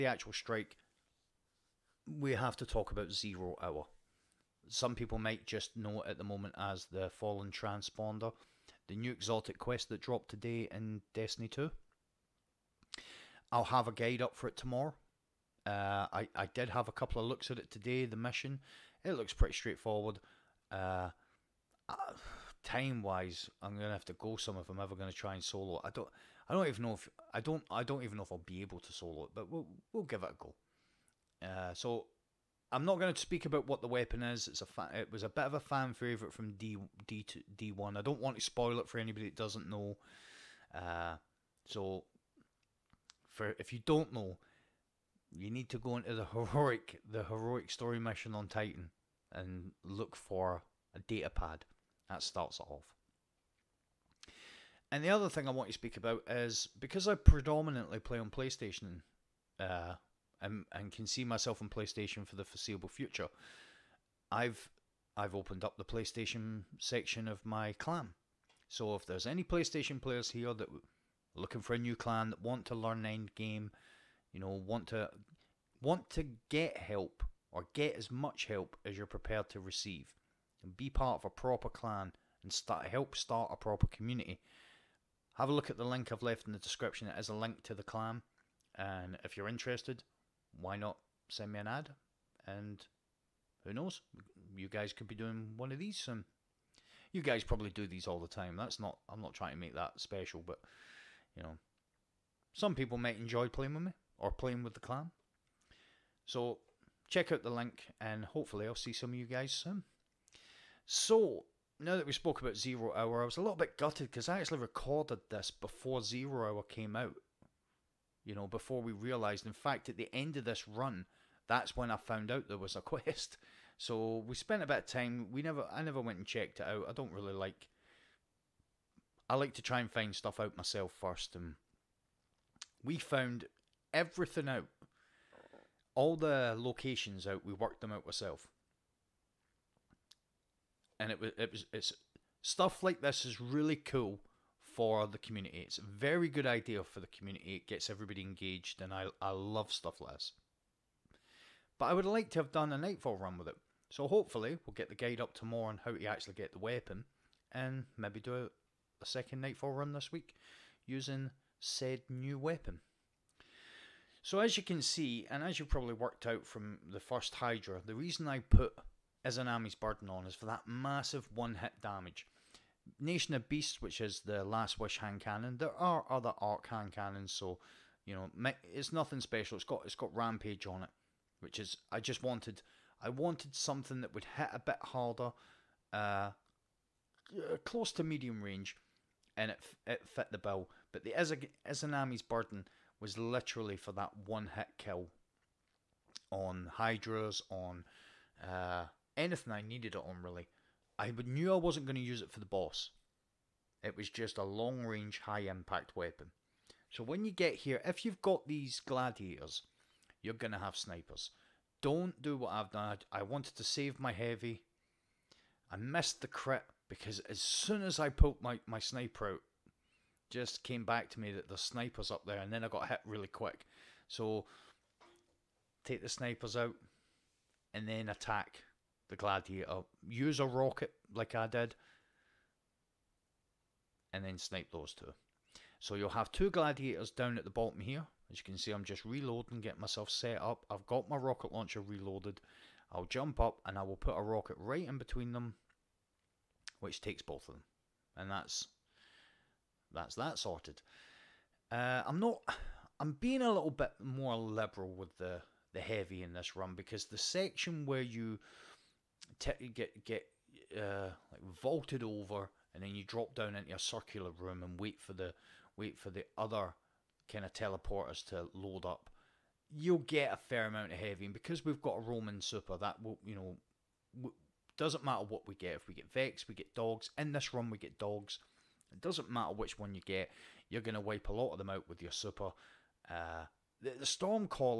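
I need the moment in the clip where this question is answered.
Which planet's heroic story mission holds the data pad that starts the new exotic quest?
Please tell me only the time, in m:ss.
0:48.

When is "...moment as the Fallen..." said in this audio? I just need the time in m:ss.
0:06.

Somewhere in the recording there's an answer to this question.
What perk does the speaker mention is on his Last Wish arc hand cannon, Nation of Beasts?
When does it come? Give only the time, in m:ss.
3:00.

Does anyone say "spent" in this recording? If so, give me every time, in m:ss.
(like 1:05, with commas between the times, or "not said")
2:04.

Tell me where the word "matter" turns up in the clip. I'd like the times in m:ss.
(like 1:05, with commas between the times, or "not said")
4:35, 4:39.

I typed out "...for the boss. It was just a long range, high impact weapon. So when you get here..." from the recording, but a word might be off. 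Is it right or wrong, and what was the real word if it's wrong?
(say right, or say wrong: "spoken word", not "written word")
right.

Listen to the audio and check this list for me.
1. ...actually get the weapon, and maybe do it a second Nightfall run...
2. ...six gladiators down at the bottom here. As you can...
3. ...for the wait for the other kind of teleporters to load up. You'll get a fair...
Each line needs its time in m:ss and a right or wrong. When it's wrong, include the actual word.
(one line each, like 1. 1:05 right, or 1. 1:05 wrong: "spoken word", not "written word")
1. 2:36 right
2. 3:56 wrong: "two", not "six"
3. 4:25 right.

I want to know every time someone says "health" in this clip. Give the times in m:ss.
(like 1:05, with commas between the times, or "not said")
not said.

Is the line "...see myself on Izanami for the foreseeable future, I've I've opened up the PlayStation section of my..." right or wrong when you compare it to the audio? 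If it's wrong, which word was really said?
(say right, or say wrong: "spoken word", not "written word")
wrong: "PlayStation", not "Izanami".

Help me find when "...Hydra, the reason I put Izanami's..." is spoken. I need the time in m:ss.
2:47.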